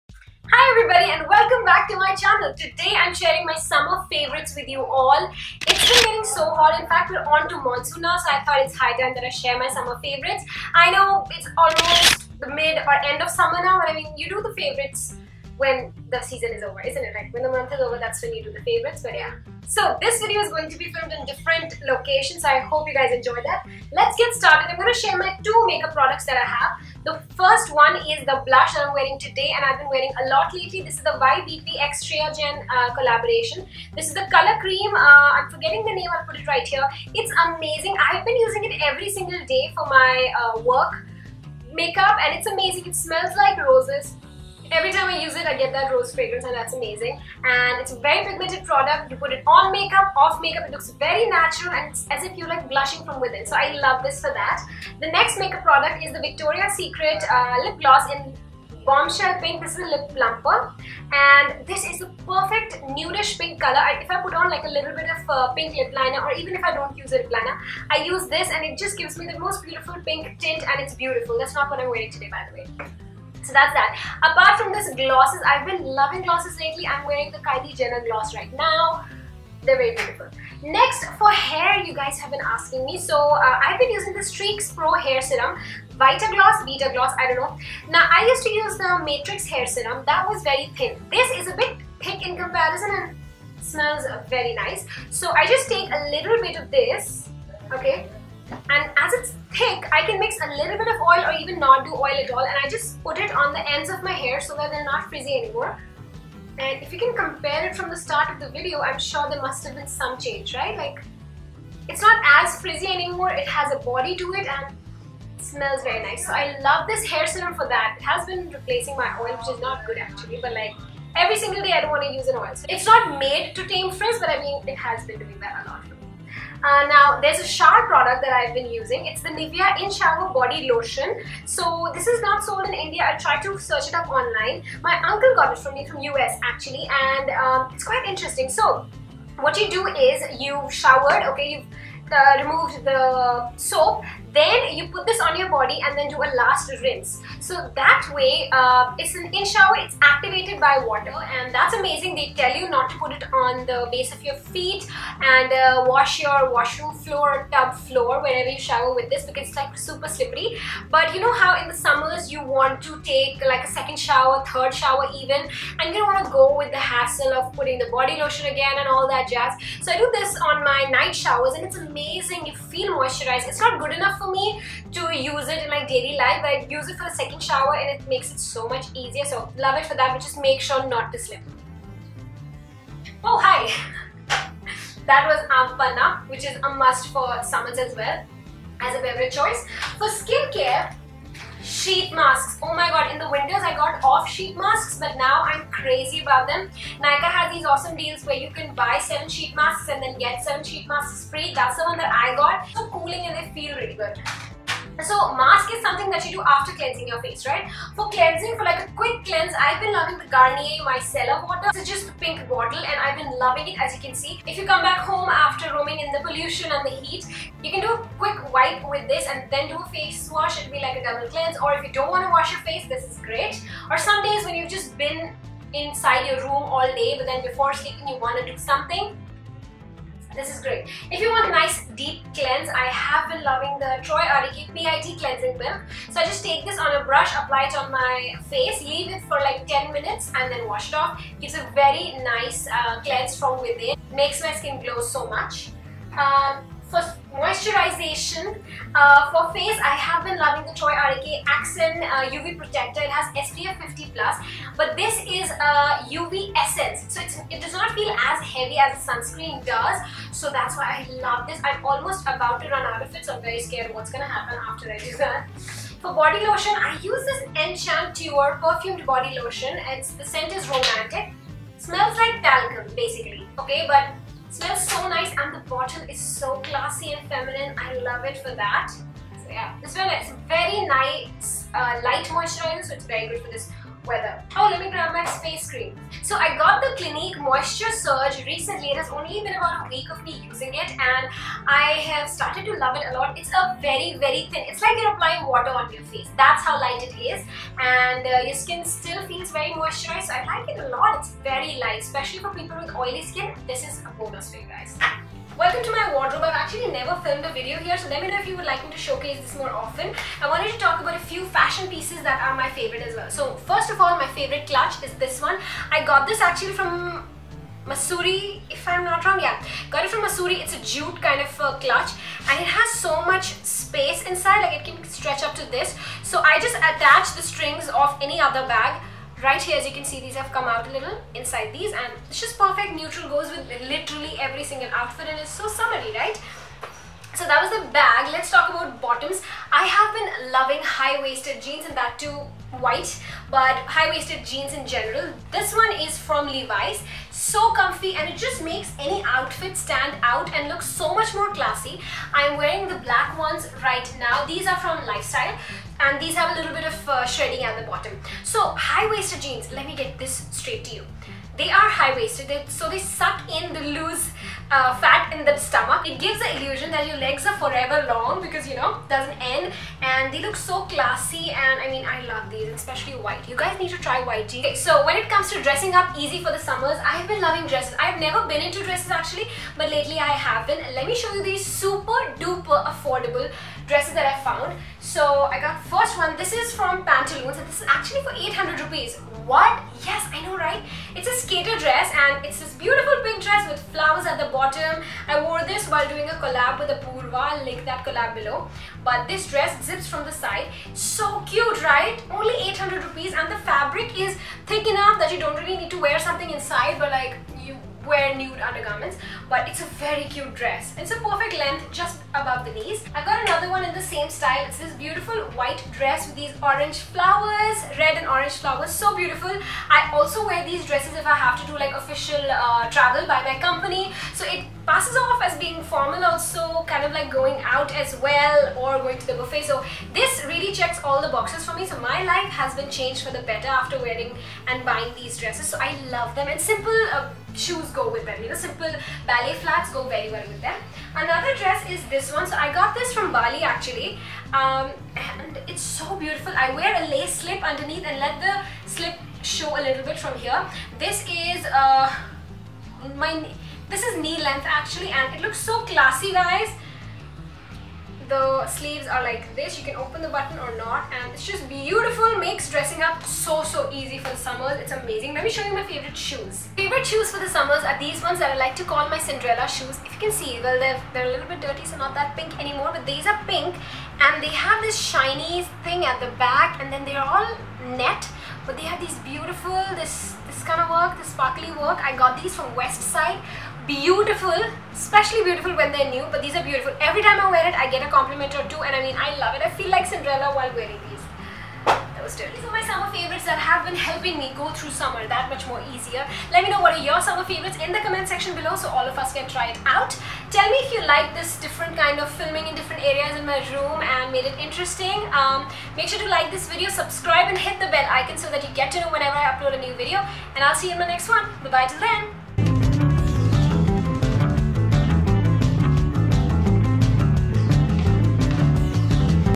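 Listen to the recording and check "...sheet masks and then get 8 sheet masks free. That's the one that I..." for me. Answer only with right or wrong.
wrong.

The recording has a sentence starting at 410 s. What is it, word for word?
It's a perfect length just above the knees.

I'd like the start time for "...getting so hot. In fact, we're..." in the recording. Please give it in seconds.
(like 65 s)
6 s.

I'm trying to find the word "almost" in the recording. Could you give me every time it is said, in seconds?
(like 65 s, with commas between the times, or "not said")
11 s, 261 s.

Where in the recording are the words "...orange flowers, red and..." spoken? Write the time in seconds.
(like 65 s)
416 s.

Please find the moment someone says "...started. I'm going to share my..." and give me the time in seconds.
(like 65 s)
24 s.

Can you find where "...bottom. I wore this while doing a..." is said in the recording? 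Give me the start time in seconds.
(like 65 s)
394 s.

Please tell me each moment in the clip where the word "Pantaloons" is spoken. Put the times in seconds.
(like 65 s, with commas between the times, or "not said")
387 s.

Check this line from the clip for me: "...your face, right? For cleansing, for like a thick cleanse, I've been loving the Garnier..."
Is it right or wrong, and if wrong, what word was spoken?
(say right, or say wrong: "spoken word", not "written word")
wrong: "quick", not "thick".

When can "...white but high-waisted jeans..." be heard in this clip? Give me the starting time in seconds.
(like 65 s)
342 s.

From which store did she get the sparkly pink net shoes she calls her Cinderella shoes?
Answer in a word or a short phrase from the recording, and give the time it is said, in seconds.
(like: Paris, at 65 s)
Westside, at 482 s.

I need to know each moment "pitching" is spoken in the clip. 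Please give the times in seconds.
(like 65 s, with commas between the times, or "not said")
not said.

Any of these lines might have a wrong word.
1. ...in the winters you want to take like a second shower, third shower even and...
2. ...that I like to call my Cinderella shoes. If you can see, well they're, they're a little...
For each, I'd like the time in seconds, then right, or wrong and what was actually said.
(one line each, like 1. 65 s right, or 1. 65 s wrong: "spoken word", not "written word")
1. 161 s wrong: "summers", not "winters"
2. 468 s right.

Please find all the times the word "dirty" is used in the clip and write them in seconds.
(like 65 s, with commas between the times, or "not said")
471 s, 492 s.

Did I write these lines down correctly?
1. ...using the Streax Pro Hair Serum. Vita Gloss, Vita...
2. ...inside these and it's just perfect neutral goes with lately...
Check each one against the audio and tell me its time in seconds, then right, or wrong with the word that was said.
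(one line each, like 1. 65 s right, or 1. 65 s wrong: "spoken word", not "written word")
1. 83 s right
2. 331 s wrong: "literally", not "lately".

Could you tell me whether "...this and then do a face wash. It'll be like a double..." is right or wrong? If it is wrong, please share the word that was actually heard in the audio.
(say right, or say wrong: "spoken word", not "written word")
right.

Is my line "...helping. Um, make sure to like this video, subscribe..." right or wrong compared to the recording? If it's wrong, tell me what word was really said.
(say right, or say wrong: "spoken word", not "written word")
wrong: "interesting", not "helping".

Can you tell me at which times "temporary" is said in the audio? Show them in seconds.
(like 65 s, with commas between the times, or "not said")
not said.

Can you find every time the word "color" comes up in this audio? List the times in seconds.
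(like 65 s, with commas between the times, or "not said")
34 s, 63 s.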